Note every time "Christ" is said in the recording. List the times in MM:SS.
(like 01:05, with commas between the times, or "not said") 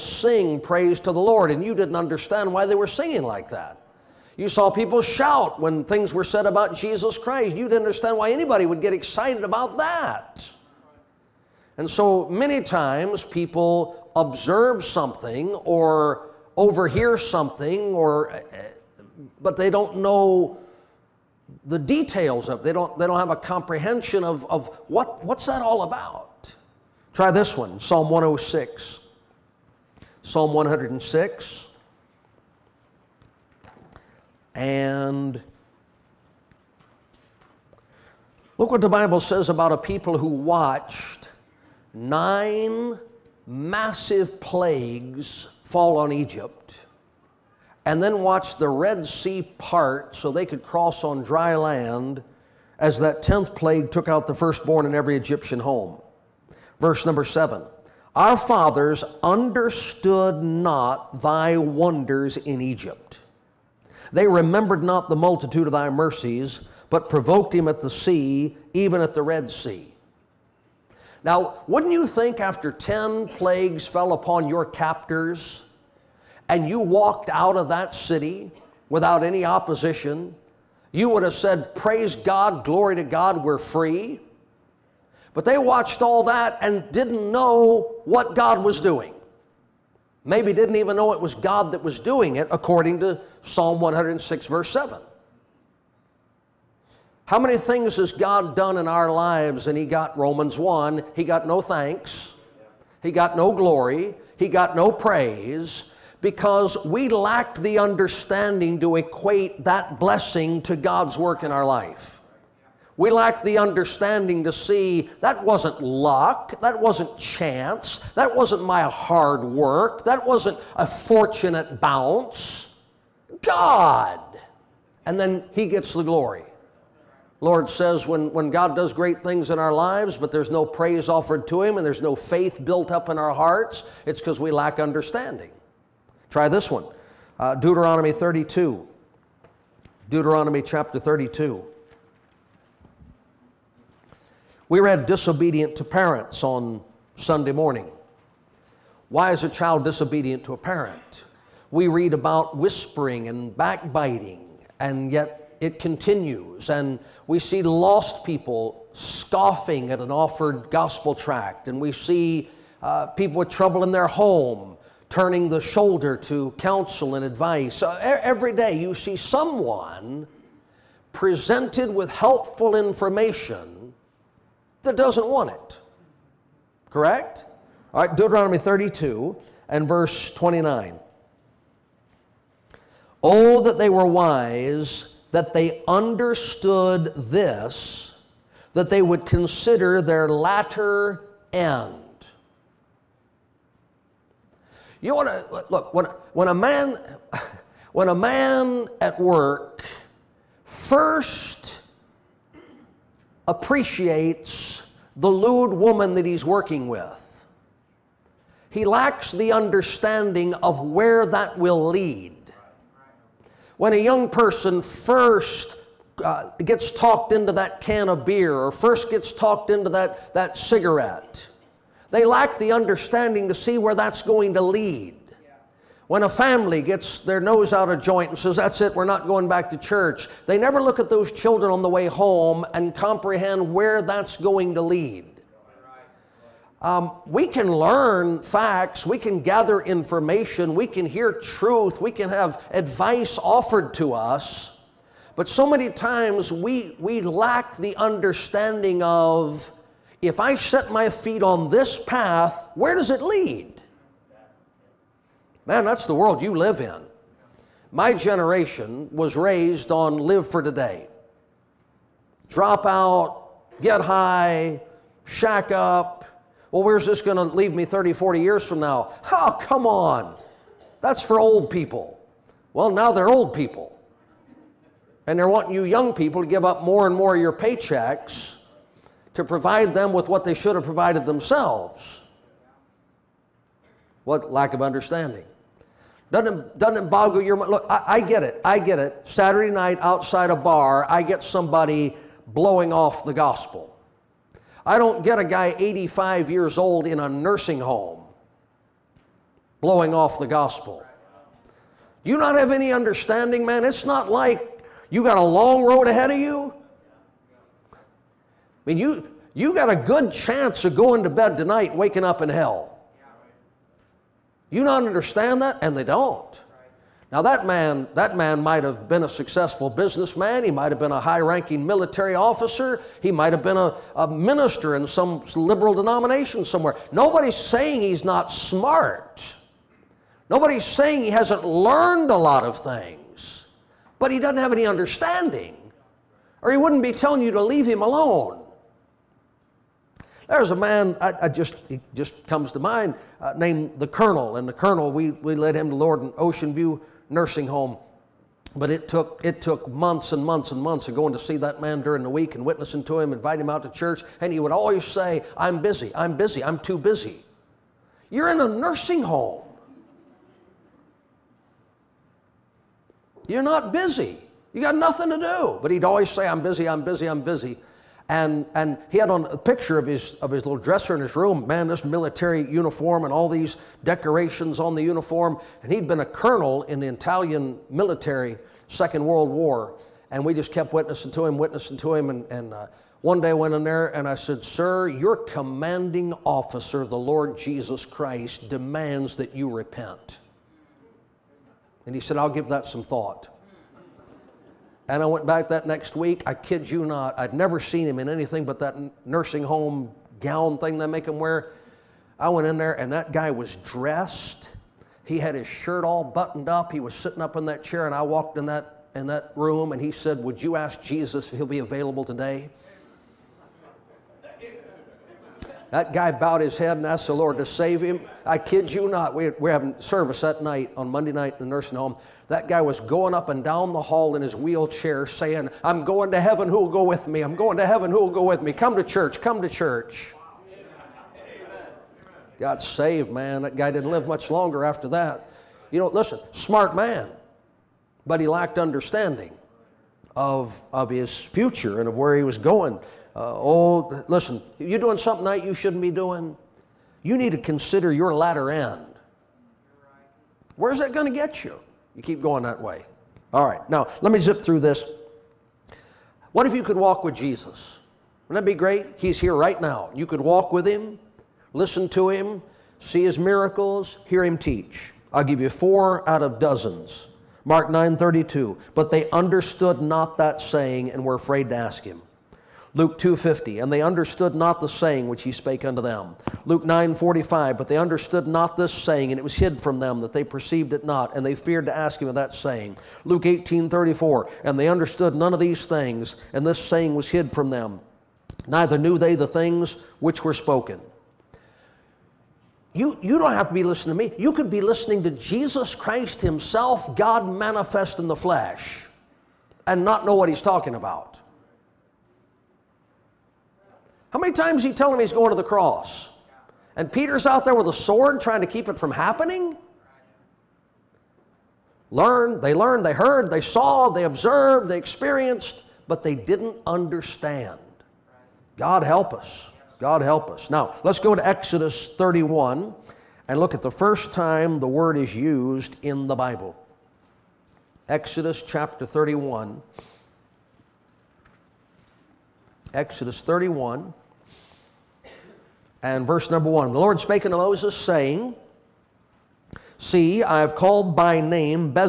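00:07, 06:28, 08:15.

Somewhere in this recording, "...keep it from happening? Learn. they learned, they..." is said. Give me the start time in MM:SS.
08:28.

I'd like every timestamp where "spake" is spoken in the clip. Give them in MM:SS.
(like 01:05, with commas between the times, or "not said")
07:55, 08:57.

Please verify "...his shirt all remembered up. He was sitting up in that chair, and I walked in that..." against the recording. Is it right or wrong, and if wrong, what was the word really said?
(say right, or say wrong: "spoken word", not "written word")
wrong: "buttoned", not "remembered".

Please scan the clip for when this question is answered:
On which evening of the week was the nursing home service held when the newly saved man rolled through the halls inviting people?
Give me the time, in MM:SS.
07:01.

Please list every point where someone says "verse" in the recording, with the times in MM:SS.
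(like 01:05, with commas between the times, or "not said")
00:56, 01:34, 02:59, 08:56.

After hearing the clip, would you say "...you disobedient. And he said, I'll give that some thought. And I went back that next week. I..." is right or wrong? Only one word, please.
wrong.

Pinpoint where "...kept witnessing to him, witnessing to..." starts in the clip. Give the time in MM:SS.
06:20.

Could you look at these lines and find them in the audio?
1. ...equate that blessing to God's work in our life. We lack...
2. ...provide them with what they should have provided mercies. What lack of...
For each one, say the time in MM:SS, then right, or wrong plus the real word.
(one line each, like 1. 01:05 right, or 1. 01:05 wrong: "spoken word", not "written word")
1. 01:48 right
2. 04:39 wrong: "themselves", not "mercies".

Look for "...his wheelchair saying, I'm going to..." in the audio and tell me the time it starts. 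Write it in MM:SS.
07:04.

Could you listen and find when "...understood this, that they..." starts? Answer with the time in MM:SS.
03:05.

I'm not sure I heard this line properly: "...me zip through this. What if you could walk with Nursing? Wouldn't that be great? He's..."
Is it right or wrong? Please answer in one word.
wrong.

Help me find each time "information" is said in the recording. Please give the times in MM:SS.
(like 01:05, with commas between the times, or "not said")
02:52, 03:59.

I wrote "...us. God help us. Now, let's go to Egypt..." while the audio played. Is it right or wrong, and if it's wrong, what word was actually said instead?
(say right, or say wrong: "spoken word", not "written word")
wrong: "Exodus", not "Egypt".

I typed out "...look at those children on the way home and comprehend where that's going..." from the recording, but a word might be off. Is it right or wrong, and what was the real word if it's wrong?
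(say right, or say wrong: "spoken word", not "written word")
right.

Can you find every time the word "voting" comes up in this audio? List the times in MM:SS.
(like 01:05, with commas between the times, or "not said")
not said.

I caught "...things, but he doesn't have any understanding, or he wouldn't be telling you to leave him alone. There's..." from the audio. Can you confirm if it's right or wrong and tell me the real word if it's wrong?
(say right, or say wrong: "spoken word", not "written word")
right.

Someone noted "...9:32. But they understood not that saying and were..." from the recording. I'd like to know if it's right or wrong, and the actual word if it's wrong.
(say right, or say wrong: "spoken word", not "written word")
right.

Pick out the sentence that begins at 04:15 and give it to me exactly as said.
Man, that's the world you live in.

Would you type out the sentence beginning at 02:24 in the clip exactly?
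We read disobedient to parents on Sunday morning.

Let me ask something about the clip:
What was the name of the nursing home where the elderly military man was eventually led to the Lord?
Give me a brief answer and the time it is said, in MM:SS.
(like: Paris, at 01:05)
Ocean View Nursing Home, at 05:46.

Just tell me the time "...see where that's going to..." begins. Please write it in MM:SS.
03:43.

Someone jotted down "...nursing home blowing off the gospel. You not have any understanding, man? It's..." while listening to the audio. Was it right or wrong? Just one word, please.
right.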